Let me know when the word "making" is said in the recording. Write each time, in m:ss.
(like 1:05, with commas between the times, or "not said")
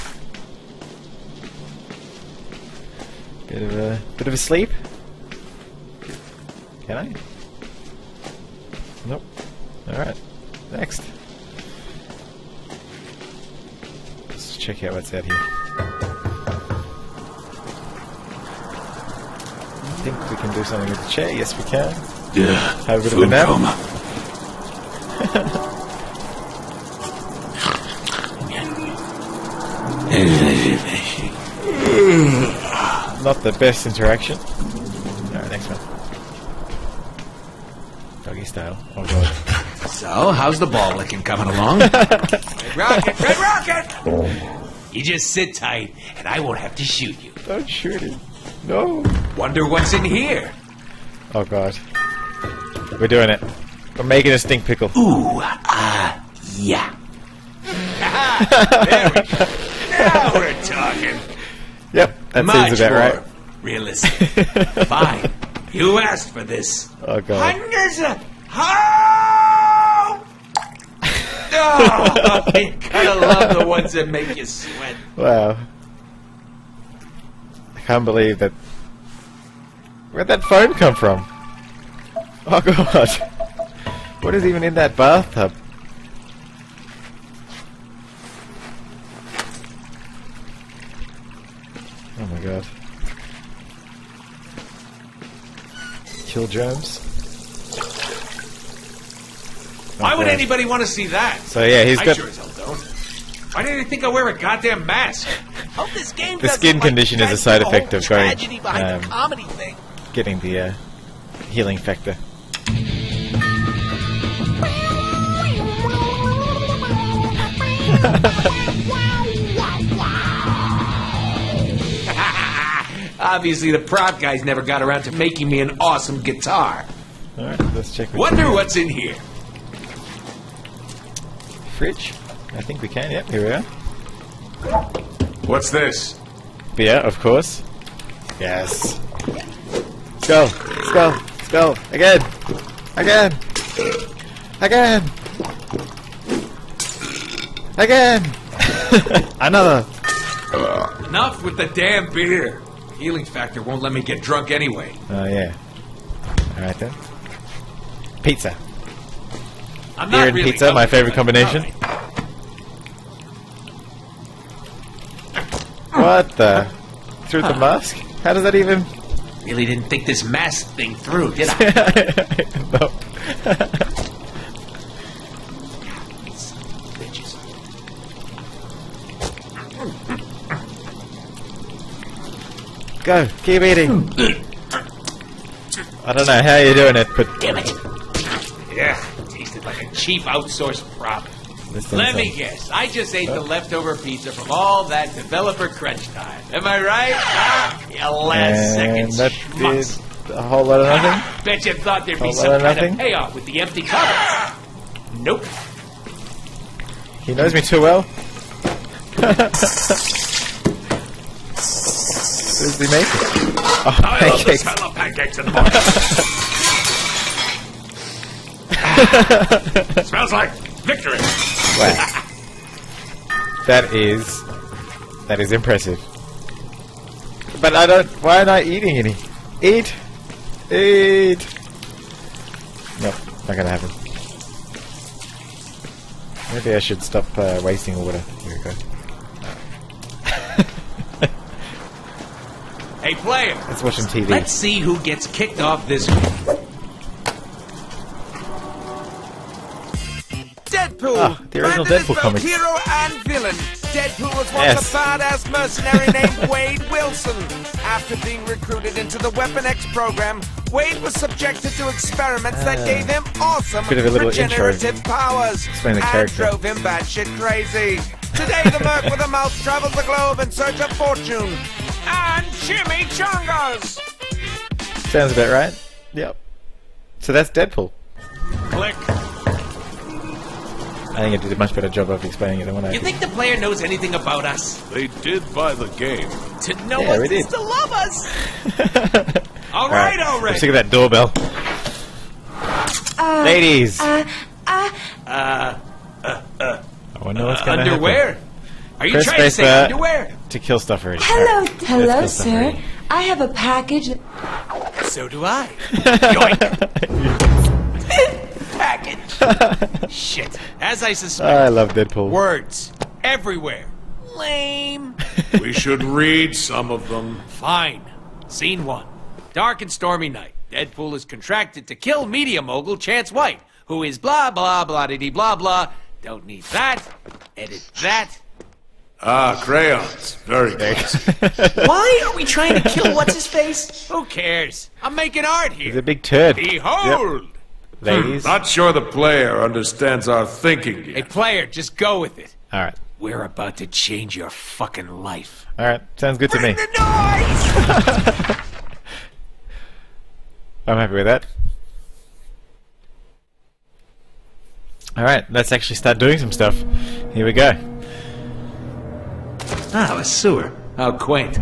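0:54, 2:05, 3:32, 5:35.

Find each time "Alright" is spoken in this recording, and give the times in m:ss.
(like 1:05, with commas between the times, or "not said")
0:09, 0:34.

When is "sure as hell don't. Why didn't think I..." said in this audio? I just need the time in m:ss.
1:42.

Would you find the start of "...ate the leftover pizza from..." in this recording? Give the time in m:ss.
3:13.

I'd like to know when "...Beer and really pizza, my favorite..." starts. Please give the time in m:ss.
2:40.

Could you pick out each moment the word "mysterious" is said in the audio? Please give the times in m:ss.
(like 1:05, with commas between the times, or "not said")
not said.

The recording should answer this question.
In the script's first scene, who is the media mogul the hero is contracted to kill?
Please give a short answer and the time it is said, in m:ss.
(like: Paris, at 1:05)
Chance White, at 5:22.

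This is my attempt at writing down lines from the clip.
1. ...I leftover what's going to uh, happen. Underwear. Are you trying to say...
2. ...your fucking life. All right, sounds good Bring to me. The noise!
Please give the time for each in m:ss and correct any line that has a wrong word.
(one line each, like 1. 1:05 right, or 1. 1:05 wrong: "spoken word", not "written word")
1. 4:57 wrong: "wonder", not "leftover"
2. 5:44 right.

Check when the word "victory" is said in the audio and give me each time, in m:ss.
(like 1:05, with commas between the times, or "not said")
3:40.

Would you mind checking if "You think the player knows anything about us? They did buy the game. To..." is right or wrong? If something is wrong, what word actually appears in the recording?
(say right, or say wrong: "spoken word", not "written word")
right.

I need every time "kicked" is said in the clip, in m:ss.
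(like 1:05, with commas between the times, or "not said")
4:05.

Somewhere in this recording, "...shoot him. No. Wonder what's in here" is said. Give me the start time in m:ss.
0:47.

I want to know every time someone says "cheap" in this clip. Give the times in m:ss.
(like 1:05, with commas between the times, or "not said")
3:09.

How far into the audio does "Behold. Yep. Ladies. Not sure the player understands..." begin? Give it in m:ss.
5:36.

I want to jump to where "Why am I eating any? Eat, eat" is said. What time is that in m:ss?
3:48.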